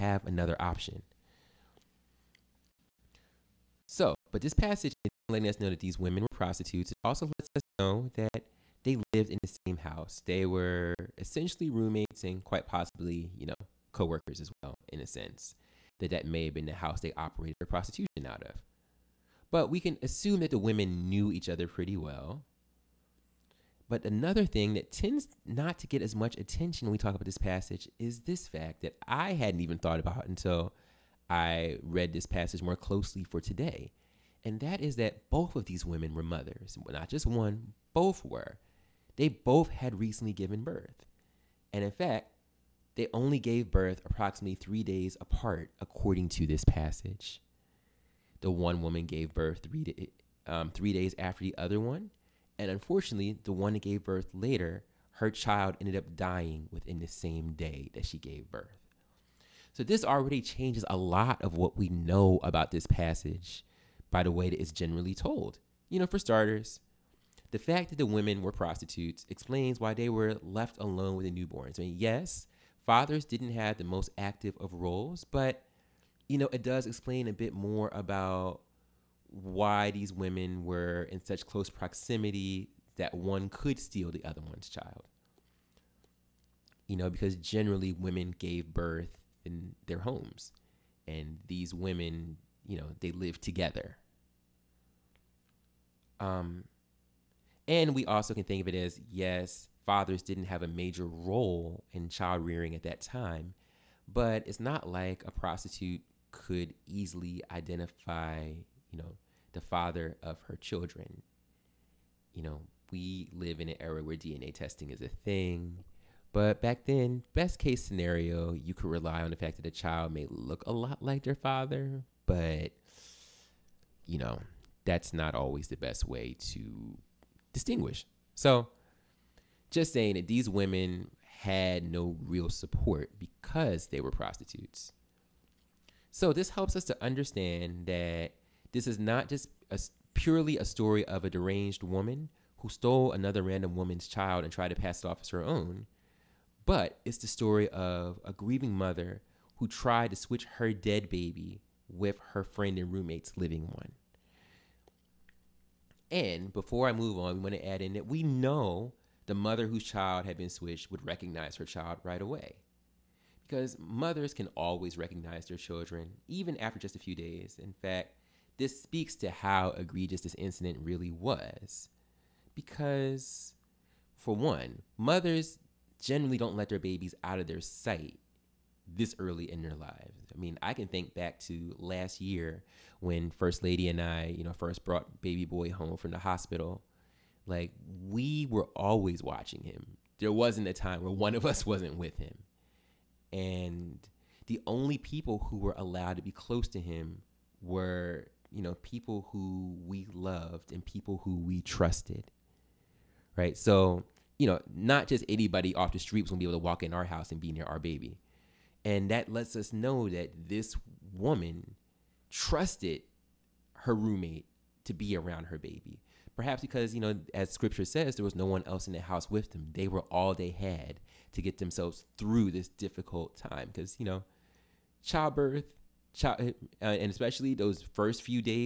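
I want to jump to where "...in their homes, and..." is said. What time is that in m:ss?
1:29.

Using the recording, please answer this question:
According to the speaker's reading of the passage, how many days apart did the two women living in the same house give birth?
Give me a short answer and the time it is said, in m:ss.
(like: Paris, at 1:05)
3, at 0:44.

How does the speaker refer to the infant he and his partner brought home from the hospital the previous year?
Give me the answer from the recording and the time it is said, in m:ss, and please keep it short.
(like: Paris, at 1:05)
baby boy, at 3:05.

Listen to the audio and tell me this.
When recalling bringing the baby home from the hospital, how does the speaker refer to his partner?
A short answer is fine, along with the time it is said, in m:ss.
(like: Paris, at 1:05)
First Lady, at 3:03.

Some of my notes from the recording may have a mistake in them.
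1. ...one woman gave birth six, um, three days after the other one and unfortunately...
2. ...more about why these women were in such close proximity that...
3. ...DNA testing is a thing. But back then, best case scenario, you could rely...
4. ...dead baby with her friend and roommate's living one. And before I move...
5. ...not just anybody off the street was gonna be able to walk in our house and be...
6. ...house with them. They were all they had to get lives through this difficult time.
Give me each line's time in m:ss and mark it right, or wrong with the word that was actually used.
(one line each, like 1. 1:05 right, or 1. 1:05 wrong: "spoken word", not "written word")
1. 0:48 wrong: "three", not "six"
2. 1:17 right
3. 1:54 right
4. 2:30 right
5. 3:24 right
6. 3:39 wrong: "themselves", not "lives".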